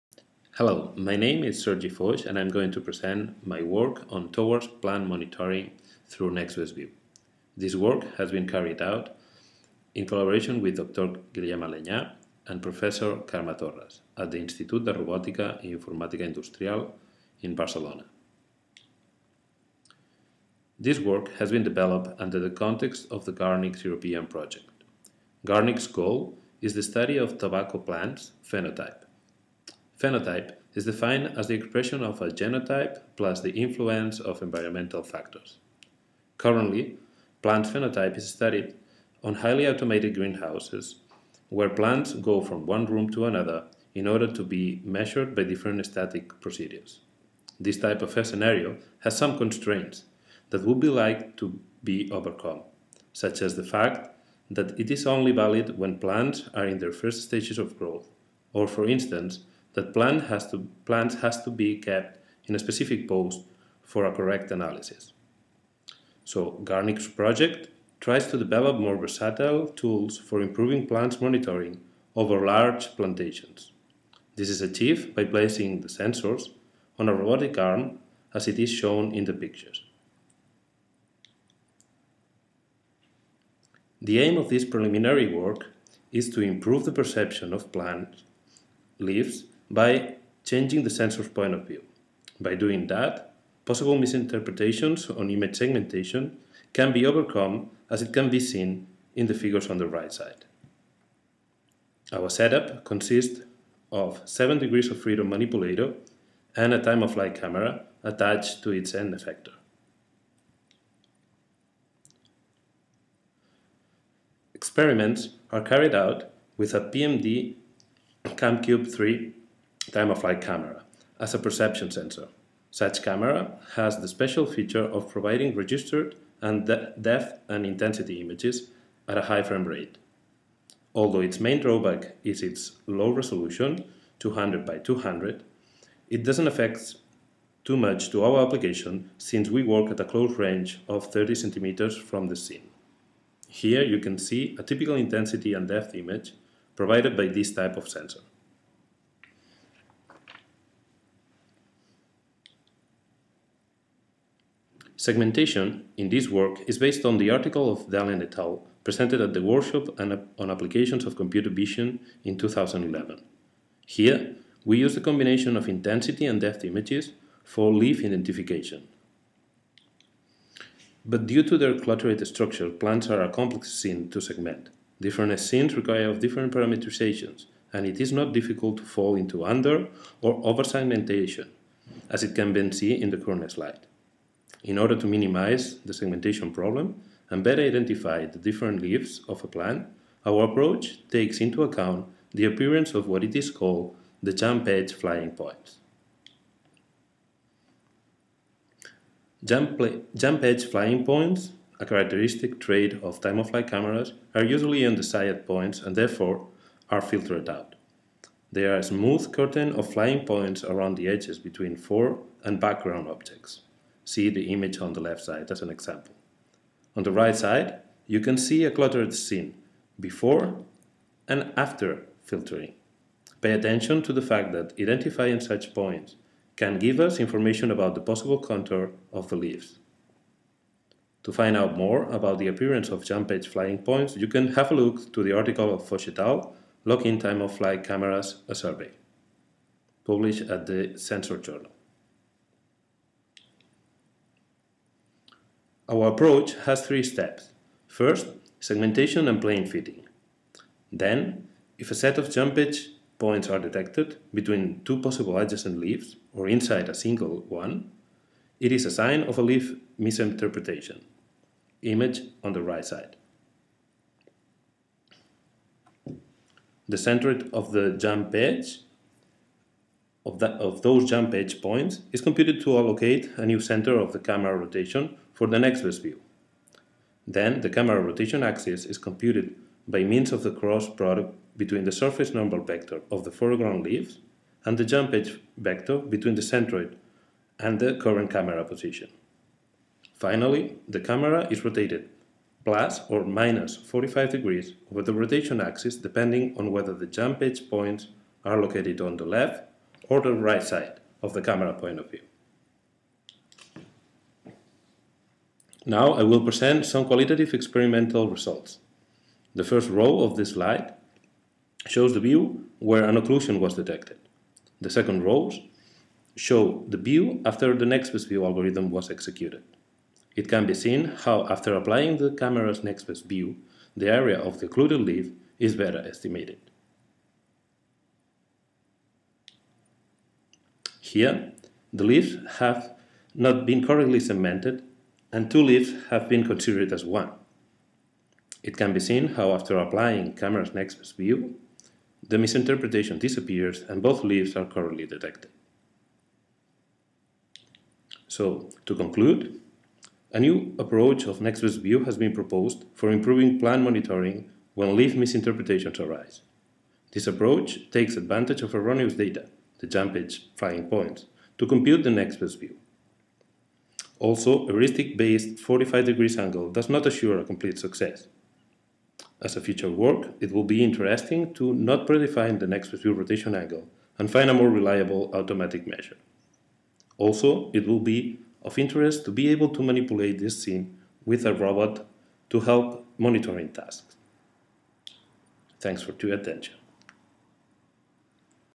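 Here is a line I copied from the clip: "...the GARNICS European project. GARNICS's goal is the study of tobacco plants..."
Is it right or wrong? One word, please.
right.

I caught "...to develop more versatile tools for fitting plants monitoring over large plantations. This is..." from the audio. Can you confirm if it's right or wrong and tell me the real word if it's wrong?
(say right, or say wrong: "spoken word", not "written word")
wrong: "improving", not "fitting".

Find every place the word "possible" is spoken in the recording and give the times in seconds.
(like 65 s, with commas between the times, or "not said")
93 s, 228 s, 255 s.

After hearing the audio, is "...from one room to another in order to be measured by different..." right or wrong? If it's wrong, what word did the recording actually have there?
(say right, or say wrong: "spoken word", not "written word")
right.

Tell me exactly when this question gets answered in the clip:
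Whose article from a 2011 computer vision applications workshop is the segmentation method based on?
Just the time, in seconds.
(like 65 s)
157 s.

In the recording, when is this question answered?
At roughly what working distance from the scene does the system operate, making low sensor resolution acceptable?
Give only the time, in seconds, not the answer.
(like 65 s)
141 s.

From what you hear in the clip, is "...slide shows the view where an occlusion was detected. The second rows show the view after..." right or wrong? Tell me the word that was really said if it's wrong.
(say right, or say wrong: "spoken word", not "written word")
right.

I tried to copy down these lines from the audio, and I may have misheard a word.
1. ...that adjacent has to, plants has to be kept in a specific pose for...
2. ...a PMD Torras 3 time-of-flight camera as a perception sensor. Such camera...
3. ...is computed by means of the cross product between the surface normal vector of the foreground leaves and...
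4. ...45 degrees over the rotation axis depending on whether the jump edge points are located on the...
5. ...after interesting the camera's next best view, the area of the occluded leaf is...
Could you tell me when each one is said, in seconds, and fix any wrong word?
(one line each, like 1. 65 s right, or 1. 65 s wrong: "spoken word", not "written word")
1. 59 s wrong: "plant", not "adjacent"
2. 116 s wrong: "CamCube", not "Torras"
3. 278 s right
4. 293 s right
5. 321 s wrong: "applying", not "interesting".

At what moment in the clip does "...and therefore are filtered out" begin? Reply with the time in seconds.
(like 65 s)
205 s.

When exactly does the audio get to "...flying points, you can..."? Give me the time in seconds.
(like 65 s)
233 s.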